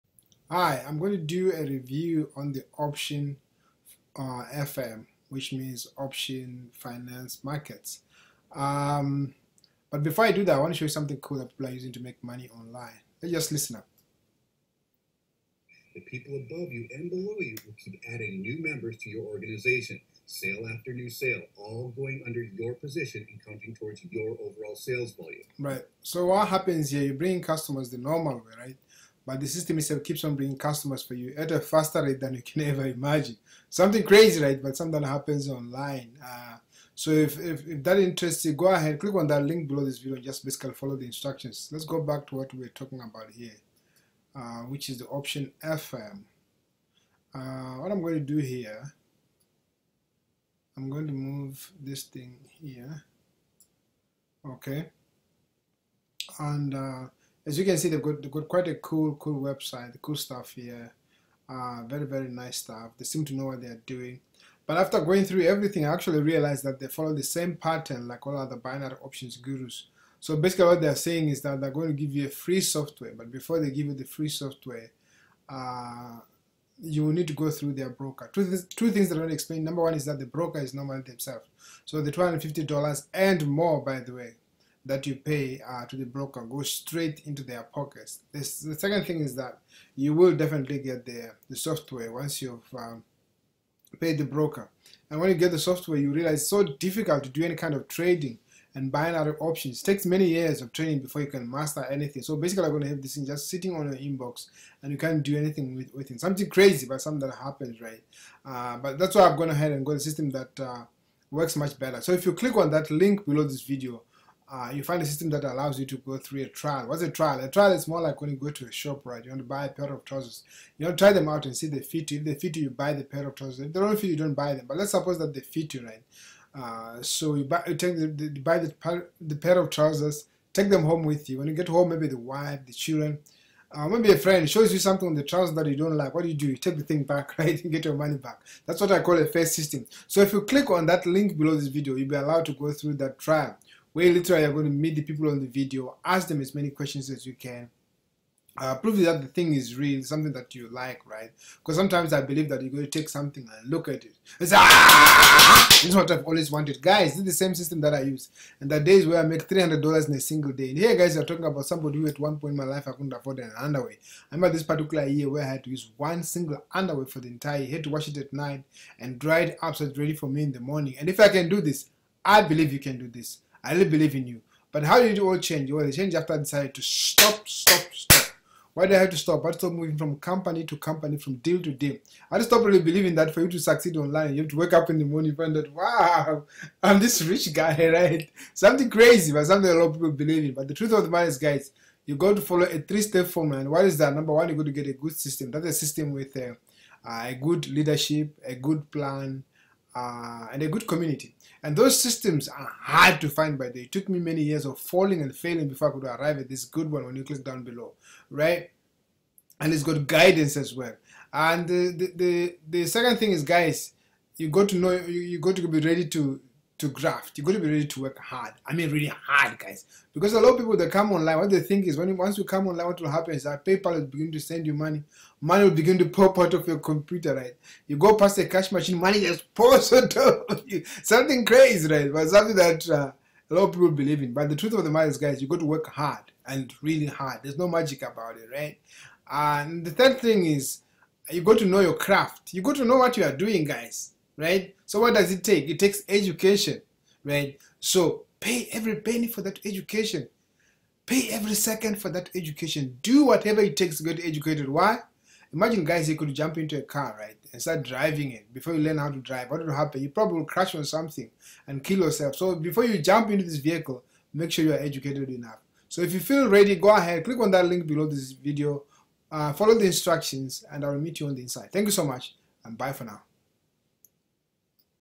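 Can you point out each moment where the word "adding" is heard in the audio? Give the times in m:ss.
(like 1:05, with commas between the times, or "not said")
0:18.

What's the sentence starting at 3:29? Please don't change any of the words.
And it's got guidance as well.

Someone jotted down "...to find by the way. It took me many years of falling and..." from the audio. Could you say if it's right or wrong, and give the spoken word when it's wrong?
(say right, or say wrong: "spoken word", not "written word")
right.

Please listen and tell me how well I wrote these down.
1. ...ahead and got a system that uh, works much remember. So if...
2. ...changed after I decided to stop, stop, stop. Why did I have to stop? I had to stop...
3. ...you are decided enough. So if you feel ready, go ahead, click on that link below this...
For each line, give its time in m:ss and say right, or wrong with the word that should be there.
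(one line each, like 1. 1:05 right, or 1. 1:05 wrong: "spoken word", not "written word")
1. 1:49 wrong: "better", not "remember"
2. 2:55 right
3. 4:24 wrong: "educated", not "decided".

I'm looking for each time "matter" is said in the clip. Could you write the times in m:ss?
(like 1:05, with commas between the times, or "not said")
3:11, 3:54.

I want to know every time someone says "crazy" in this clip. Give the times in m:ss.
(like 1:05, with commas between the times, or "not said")
0:34, 1:46, 3:08, 3:51.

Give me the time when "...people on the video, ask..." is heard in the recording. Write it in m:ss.
2:25.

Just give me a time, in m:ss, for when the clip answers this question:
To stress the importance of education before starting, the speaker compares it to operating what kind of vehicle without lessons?
4:16.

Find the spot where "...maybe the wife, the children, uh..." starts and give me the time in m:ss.
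2:11.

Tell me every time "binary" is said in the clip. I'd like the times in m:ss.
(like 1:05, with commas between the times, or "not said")
1:08, 1:38.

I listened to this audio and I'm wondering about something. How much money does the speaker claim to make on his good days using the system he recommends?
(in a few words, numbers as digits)
$300.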